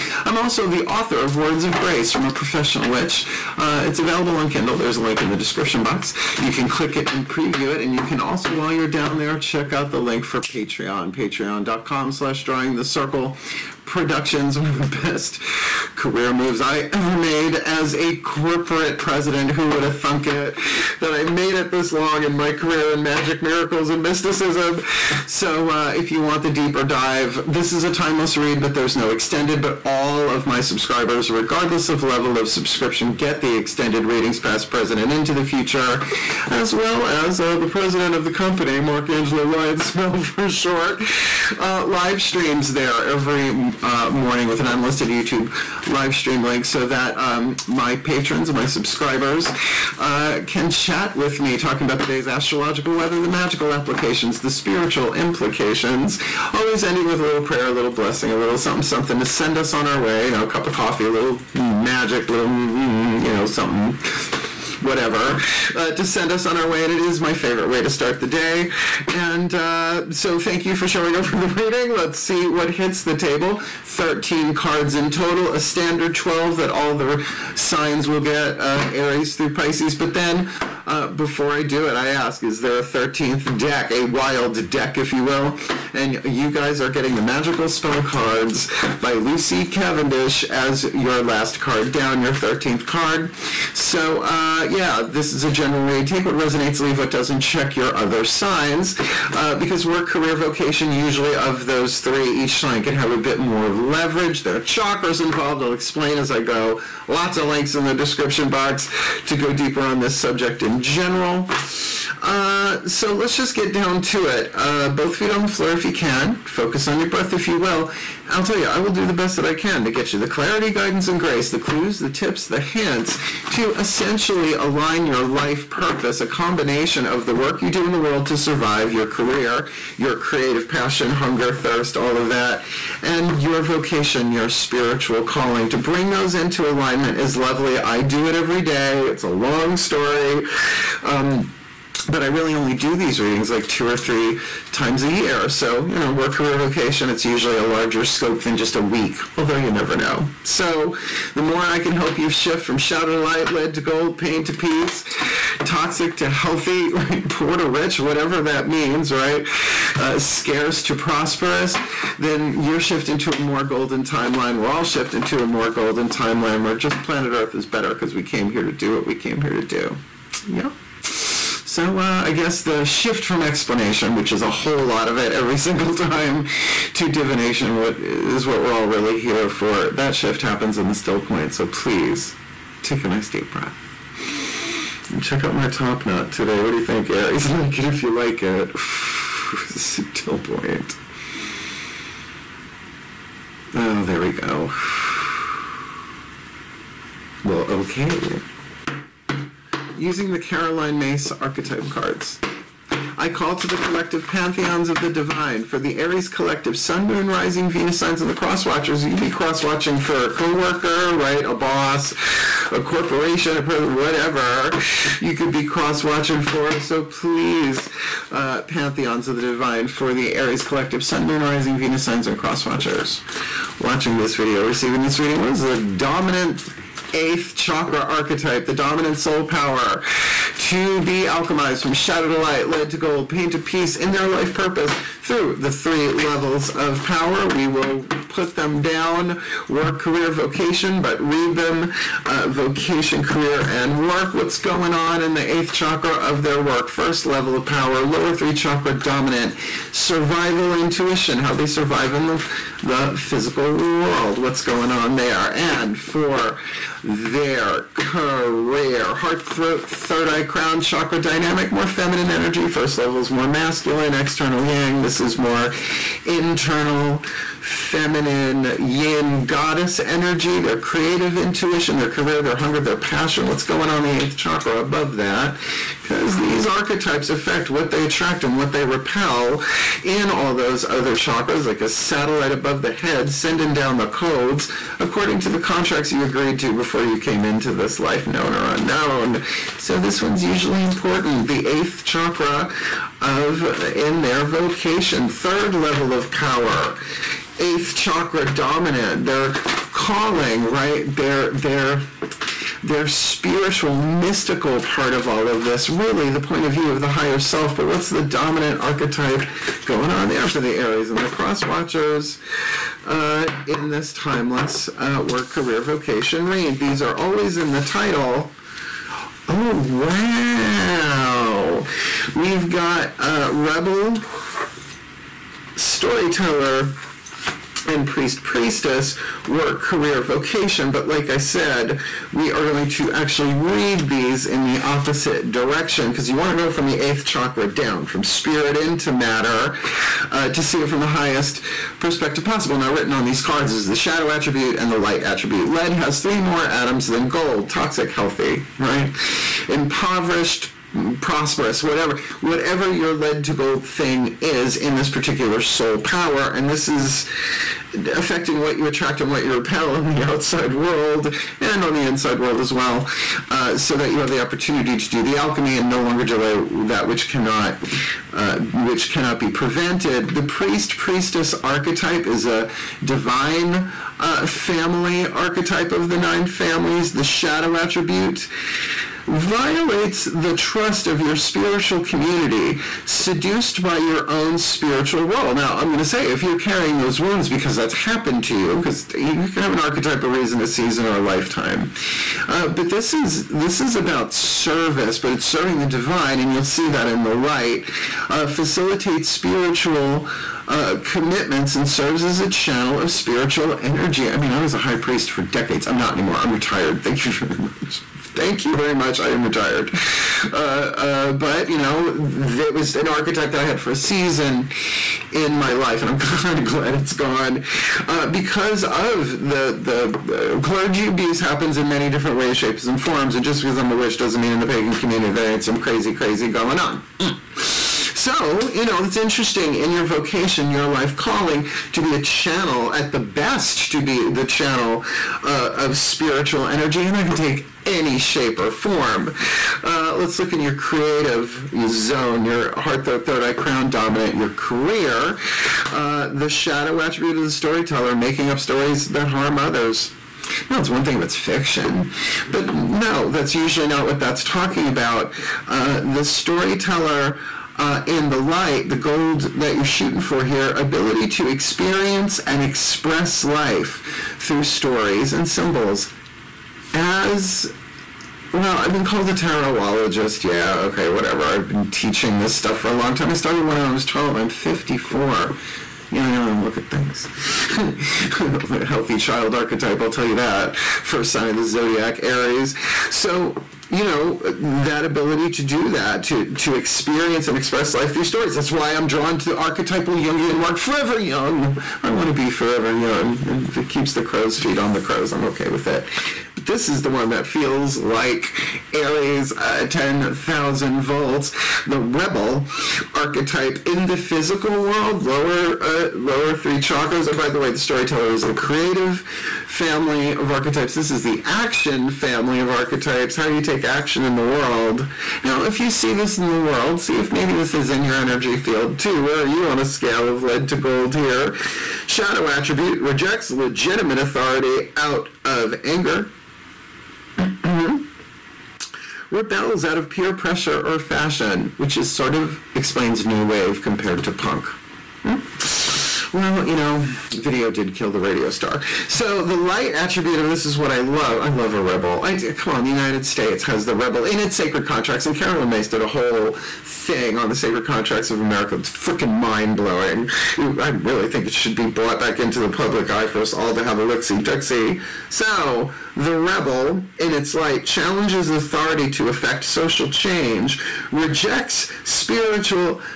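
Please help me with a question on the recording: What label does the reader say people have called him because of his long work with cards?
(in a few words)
tarotologist.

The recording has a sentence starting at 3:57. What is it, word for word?
We will put them down work, career, vocation, but read them uh, vocation, career, and work.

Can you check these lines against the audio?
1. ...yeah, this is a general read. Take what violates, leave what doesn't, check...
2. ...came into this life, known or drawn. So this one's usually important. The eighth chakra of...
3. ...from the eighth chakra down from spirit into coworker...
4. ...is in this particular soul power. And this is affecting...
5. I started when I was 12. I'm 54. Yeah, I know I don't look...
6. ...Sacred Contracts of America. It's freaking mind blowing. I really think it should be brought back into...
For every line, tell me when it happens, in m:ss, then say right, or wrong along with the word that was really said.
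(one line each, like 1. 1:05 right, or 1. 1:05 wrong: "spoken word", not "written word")
1. 1:34 wrong: "resonates", not "violates"
2. 4:47 wrong: "unknown", not "drawn"
3. 5:36 wrong: "matter", not "coworker"
4. 5:54 right
5. 7:53 right
6. 9:07 right.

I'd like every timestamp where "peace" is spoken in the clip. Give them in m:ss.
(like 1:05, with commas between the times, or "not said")
2:34, 3:53.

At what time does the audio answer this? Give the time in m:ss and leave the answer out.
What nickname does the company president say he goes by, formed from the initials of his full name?
0:39.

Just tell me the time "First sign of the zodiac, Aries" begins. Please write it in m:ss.
8:00.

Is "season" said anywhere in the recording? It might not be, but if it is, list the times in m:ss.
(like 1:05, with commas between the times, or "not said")
6:30, 6:53.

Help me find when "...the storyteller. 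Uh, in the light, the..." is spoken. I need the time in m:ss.
7:36.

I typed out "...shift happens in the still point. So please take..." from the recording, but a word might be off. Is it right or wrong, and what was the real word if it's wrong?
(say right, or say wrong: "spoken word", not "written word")
right.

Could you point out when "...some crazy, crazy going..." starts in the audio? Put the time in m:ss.
7:05.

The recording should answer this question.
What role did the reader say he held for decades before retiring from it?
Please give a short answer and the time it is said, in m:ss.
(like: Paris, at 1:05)
high priest, at 6:44.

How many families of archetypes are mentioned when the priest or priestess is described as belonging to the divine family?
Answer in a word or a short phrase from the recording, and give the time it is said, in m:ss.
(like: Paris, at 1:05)
9, at 6:16.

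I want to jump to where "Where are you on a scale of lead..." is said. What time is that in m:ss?
8:39.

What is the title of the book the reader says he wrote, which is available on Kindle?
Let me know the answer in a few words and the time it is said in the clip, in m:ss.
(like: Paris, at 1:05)
Words of Grace from a Professional Witch, at 0:01.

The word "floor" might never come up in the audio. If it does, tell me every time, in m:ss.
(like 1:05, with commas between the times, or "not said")
1:55.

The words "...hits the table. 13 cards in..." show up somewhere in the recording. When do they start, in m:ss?
1:12.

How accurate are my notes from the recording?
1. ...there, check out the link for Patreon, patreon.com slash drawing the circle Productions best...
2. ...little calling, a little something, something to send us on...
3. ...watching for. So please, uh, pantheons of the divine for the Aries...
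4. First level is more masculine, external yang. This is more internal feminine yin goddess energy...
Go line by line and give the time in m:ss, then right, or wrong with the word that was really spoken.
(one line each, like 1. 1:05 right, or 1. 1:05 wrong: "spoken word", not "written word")
1. 0:09 right
2. 0:57 wrong: "blessing", not "calling"
3. 3:36 right
4. 4:22 right.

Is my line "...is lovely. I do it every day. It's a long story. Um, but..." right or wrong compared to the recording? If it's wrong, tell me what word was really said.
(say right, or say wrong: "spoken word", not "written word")
right.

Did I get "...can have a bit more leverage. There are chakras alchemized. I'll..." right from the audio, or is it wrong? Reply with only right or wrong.
wrong.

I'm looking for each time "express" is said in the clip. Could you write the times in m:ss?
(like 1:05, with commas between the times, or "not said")
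7:42, 8:07.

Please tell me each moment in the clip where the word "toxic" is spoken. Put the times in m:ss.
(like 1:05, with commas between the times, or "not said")
2:35, 5:47.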